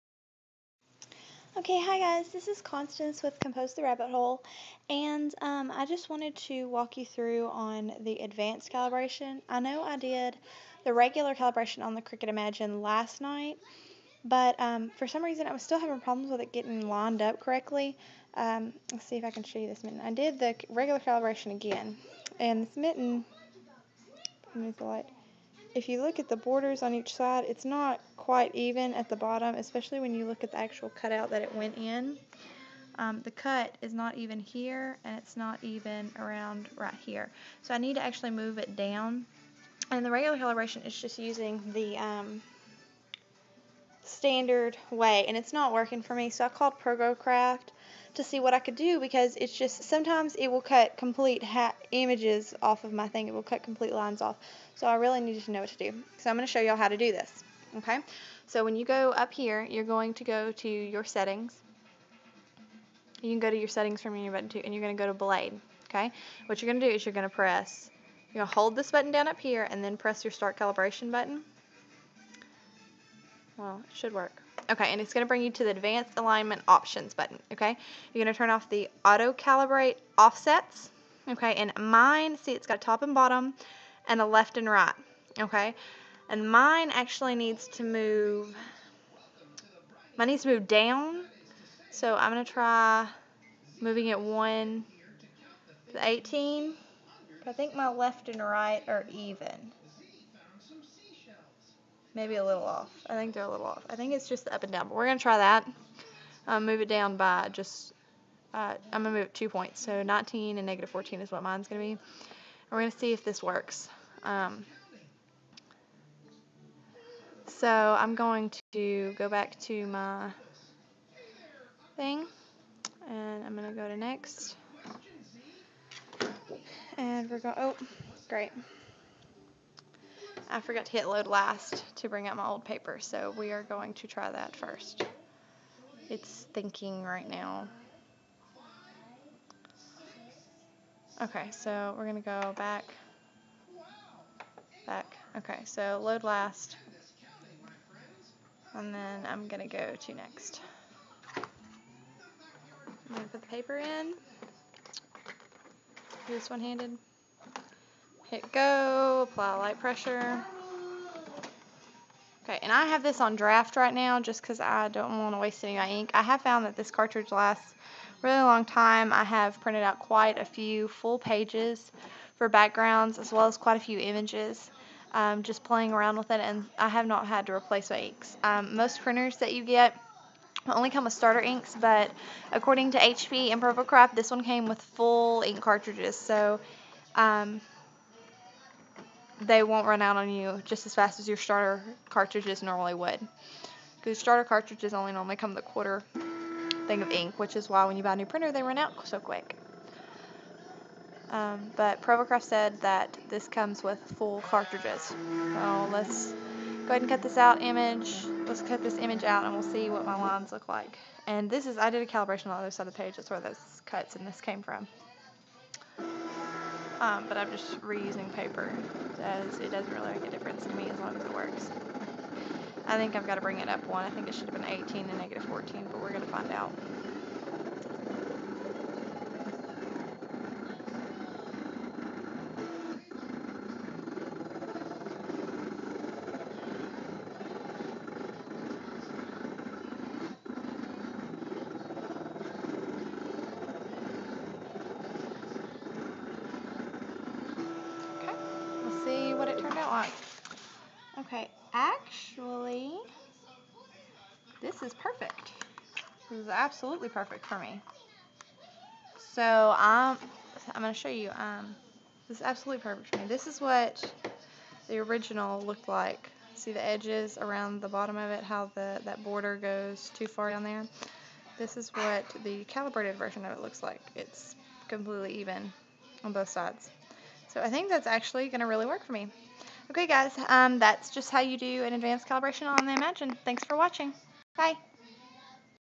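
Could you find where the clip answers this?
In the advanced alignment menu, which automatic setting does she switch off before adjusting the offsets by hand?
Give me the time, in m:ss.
1:19.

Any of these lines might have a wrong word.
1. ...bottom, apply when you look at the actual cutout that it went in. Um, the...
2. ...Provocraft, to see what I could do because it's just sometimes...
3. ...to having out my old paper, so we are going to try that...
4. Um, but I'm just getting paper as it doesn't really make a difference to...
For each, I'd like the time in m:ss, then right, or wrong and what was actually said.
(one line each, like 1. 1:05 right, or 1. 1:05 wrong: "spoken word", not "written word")
1. 0:29 wrong: "especially", not "apply"
2. 0:46 right
3. 2:11 wrong: "bring", not "having"
4. 3:37 wrong: "reusing", not "getting".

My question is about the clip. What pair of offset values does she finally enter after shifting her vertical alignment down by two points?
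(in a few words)
19 and -14.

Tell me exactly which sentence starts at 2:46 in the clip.
I have found that this cartridge lasts really long time.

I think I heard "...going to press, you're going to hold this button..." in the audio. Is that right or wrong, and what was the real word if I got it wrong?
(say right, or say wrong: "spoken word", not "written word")
right.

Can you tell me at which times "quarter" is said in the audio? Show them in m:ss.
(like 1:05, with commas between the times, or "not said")
3:15.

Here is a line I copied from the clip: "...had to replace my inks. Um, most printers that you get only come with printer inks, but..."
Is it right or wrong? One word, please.
wrong.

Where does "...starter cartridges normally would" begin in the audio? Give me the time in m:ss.
3:11.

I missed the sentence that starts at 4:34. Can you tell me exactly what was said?
It's completely even on both sides.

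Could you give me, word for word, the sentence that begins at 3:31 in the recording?
And this is, I did a calibration on the other side of the page.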